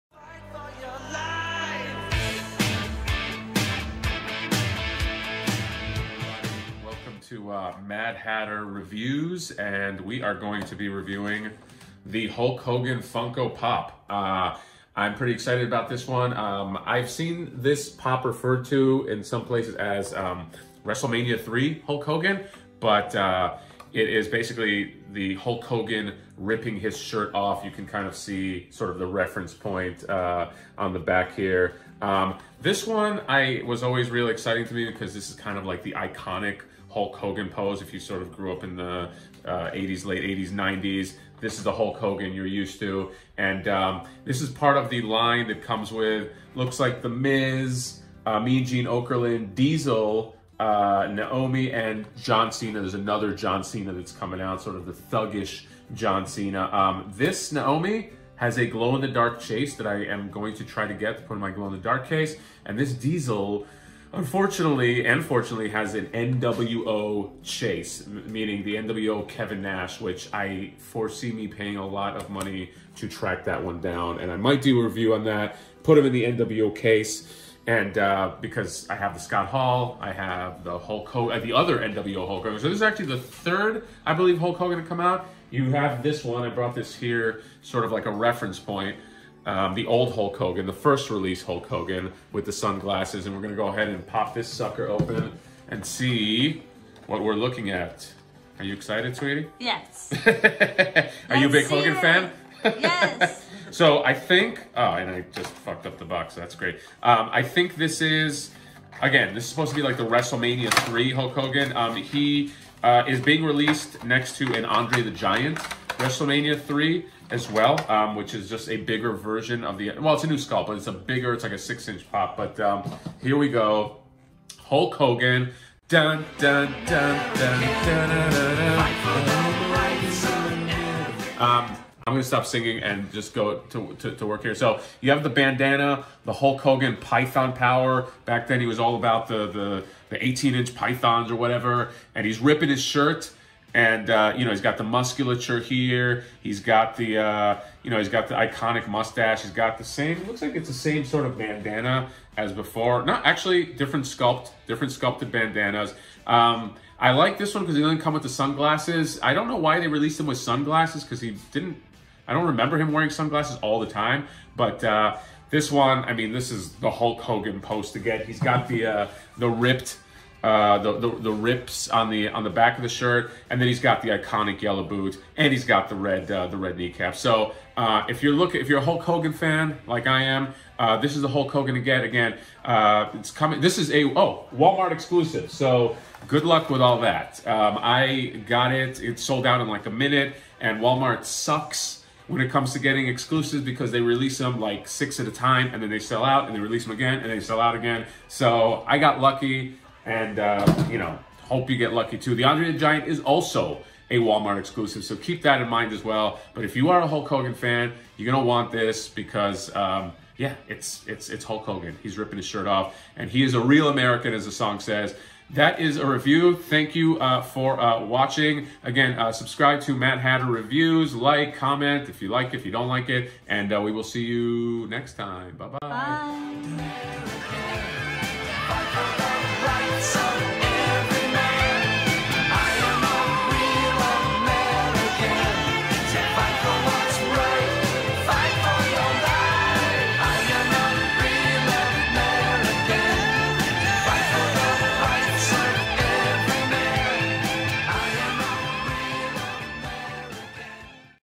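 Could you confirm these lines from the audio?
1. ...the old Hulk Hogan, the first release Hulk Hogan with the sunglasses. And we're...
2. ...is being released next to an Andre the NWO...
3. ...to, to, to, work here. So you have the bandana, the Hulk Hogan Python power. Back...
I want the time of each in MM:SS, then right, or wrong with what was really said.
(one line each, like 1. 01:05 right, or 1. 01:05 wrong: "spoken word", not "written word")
1. 01:29 right
2. 01:53 wrong: "Giant", not "NWO"
3. 02:13 right.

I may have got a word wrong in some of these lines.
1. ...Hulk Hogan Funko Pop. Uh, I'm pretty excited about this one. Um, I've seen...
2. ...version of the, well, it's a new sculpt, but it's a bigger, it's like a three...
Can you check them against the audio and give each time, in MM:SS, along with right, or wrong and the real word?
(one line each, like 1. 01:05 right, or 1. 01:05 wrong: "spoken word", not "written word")
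1. 00:12 right
2. 01:59 wrong: "six", not "three".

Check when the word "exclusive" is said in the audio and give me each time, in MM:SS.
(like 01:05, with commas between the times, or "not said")
03:04, 03:13, 03:24.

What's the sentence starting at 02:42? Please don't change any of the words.
I don't remember him wearing sunglasses all the time, but.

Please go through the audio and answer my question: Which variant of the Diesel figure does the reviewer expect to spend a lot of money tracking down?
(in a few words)
NWO chase.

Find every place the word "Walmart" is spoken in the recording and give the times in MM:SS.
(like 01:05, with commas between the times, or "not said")
03:04, 03:10, 03:24.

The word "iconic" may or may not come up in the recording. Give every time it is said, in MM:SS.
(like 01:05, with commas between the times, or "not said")
00:35, 02:28, 02:54.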